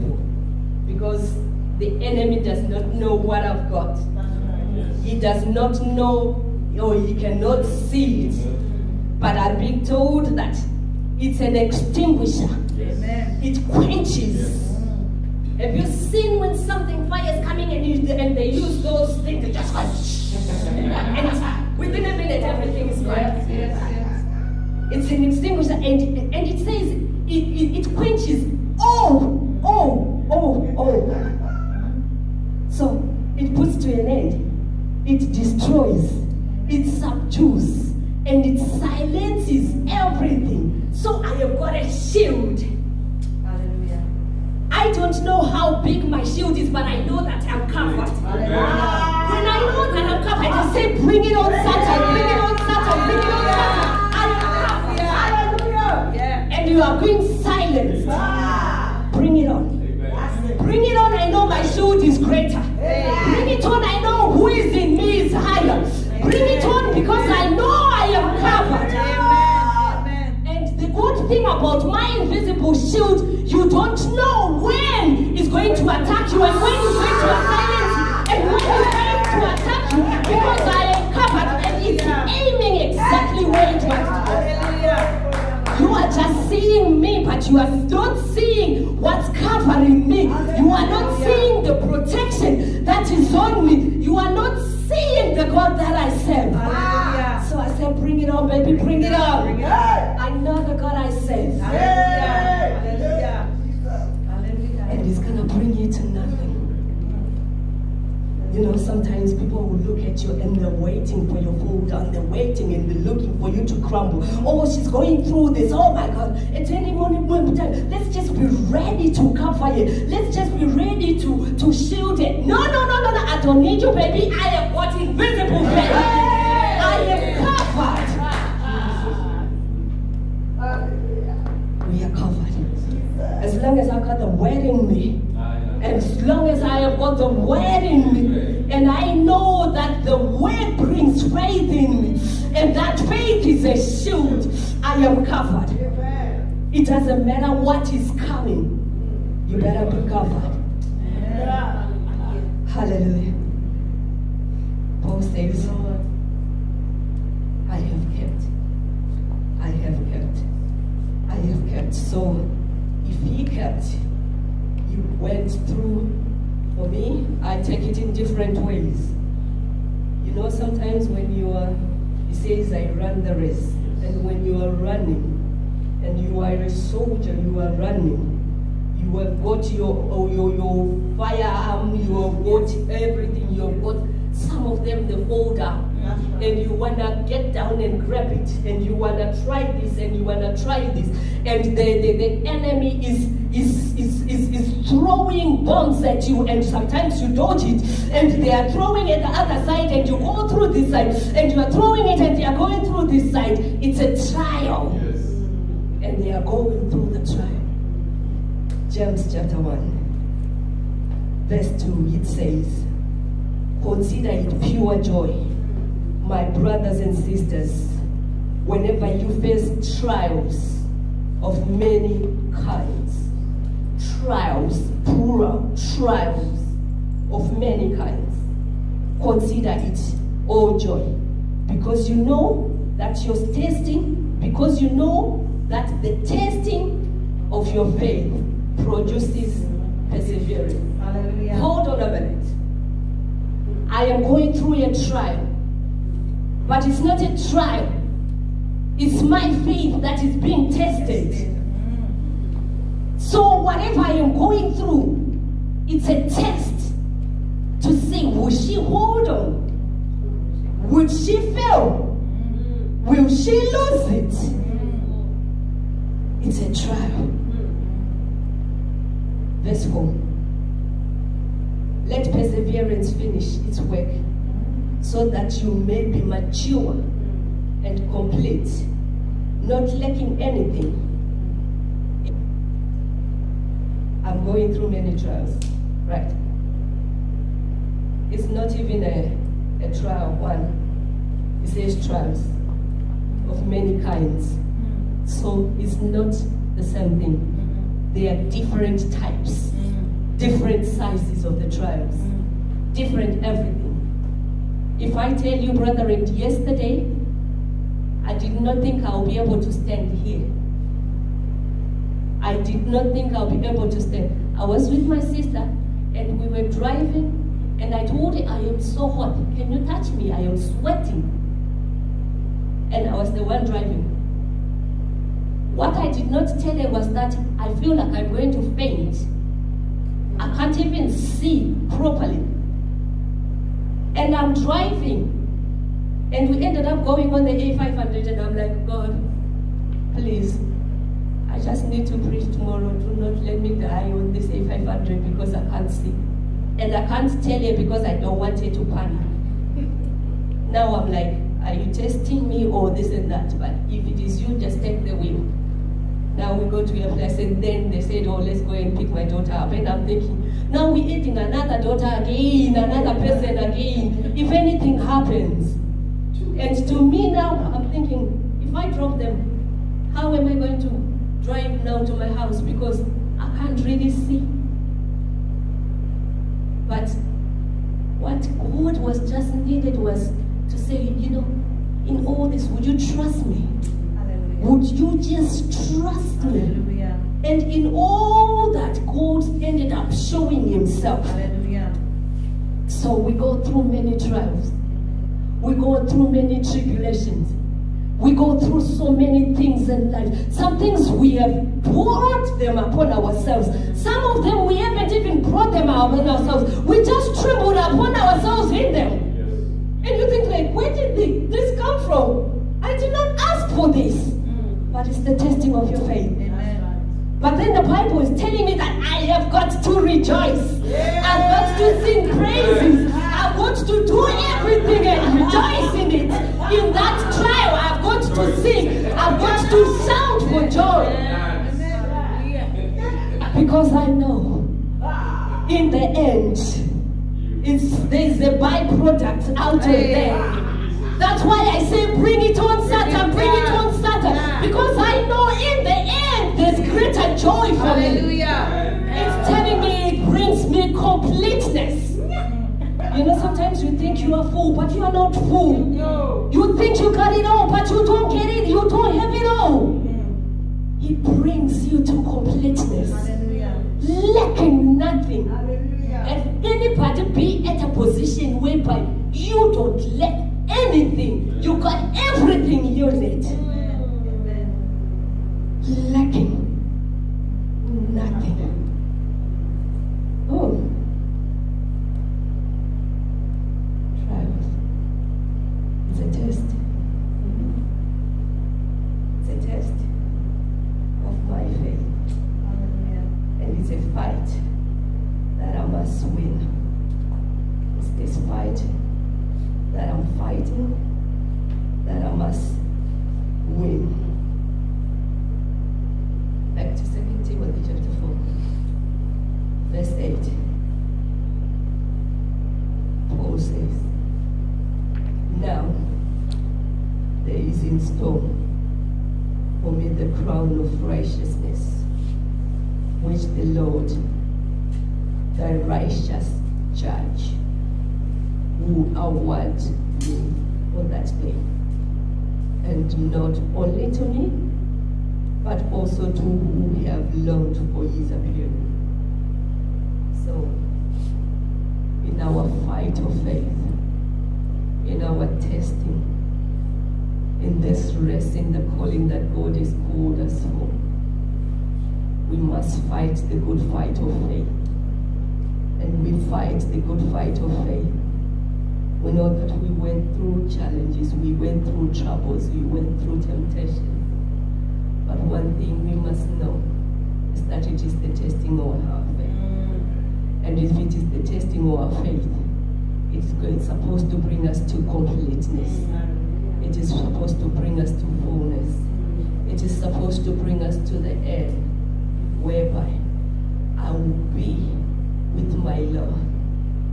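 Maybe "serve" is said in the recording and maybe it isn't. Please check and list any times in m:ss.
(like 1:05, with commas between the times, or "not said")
1:36, 1:41.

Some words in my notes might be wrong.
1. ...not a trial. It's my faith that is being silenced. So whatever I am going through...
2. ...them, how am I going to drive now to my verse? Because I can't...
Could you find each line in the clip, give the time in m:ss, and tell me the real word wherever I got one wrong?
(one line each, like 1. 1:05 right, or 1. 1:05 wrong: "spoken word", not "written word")
1. 4:06 wrong: "tested", not "silenced"
2. 6:09 wrong: "house", not "verse".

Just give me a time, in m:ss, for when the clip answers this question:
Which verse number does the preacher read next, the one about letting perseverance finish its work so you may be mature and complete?
4:29.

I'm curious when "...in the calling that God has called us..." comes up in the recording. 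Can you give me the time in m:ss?
9:08.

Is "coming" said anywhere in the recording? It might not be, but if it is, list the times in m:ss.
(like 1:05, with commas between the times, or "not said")
0:17, 2:28.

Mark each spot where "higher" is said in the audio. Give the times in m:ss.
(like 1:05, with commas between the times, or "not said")
1:05.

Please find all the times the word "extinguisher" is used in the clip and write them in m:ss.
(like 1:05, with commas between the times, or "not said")
0:11, 0:25.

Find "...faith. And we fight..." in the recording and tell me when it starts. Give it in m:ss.
9:14.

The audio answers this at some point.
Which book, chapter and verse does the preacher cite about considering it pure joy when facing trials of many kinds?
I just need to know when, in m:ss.
3:28.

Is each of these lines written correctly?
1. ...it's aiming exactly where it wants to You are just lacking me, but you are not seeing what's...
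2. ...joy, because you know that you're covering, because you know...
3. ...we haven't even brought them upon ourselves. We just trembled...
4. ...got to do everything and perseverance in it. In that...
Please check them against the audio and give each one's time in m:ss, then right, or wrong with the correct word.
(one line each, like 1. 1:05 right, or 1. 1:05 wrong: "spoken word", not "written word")
1. 1:21 wrong: "seeing", not "lacking"
2. 3:50 wrong: "testing", not "covering"
3. 6:44 right
4. 7:03 wrong: "rejoice", not "perseverance".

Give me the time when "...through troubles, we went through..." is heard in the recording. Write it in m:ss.
9:21.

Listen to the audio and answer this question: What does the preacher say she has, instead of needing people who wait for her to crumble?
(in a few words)
Invisible faith.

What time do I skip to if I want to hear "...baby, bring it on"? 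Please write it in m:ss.
1:38.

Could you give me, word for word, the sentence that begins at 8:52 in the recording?
And not only to me, but also to who have longed for his appearing.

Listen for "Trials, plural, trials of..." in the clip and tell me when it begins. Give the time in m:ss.
3:44.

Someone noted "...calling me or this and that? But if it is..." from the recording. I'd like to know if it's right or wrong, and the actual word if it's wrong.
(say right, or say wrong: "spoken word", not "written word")
wrong: "testing", not "calling".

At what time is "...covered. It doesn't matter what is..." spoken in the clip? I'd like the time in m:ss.
2:25.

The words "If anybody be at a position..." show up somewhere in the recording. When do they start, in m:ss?
7:46.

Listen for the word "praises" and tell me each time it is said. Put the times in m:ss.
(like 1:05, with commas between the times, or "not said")
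7:02.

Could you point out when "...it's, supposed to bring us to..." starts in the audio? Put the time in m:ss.
9:33.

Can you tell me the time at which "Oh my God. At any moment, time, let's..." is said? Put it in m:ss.
1:55.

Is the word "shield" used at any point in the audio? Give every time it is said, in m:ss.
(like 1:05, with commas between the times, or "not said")
0:46, 1:01, 1:12, 2:01, 2:23.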